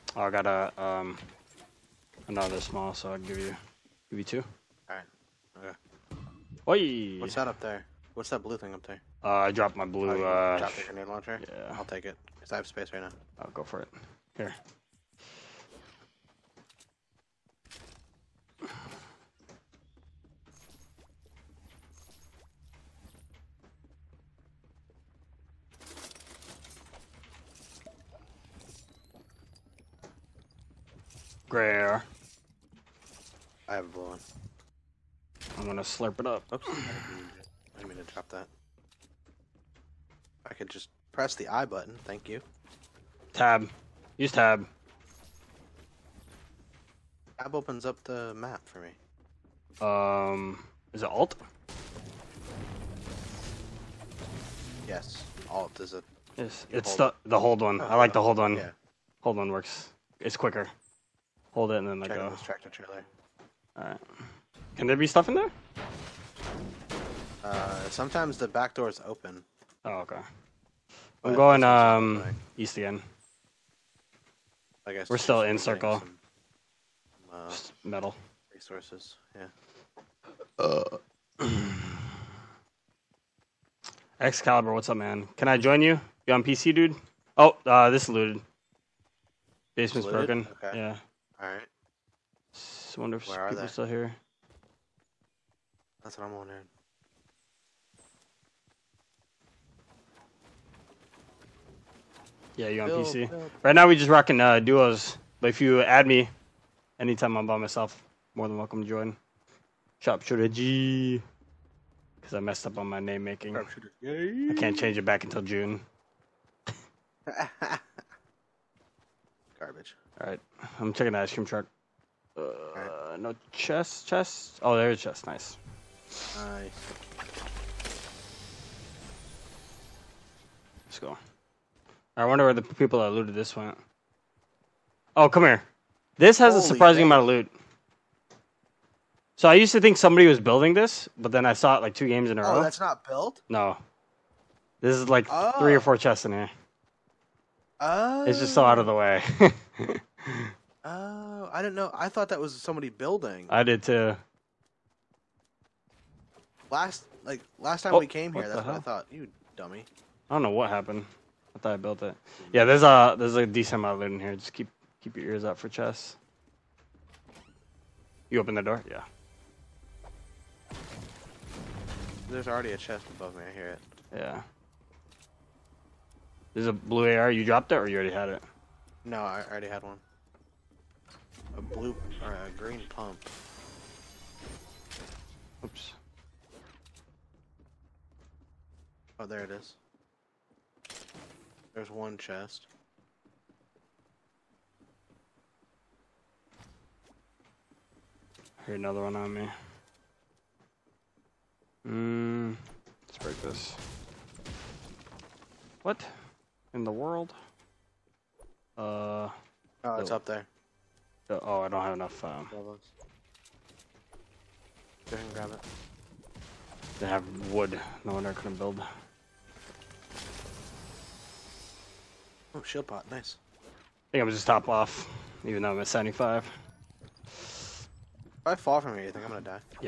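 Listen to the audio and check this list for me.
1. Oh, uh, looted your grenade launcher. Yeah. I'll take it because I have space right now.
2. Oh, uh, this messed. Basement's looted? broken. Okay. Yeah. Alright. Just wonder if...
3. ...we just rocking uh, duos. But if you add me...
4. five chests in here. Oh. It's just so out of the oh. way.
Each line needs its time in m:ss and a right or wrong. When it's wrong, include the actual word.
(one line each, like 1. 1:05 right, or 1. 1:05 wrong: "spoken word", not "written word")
1. 0:10 wrong: "dropped", not "looted"
2. 1:27 wrong: "looted", not "messed"
3. 1:43 right
4. 2:25 wrong: "four", not "five".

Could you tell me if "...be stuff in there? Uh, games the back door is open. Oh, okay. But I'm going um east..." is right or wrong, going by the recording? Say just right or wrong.
wrong.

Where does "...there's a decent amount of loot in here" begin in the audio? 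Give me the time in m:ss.
2:43.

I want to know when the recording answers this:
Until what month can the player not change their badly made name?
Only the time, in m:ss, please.
1:55.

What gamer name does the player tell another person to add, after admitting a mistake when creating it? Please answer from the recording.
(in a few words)
Sharpshooter G.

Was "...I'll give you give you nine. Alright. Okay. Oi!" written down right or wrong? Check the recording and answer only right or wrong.
wrong.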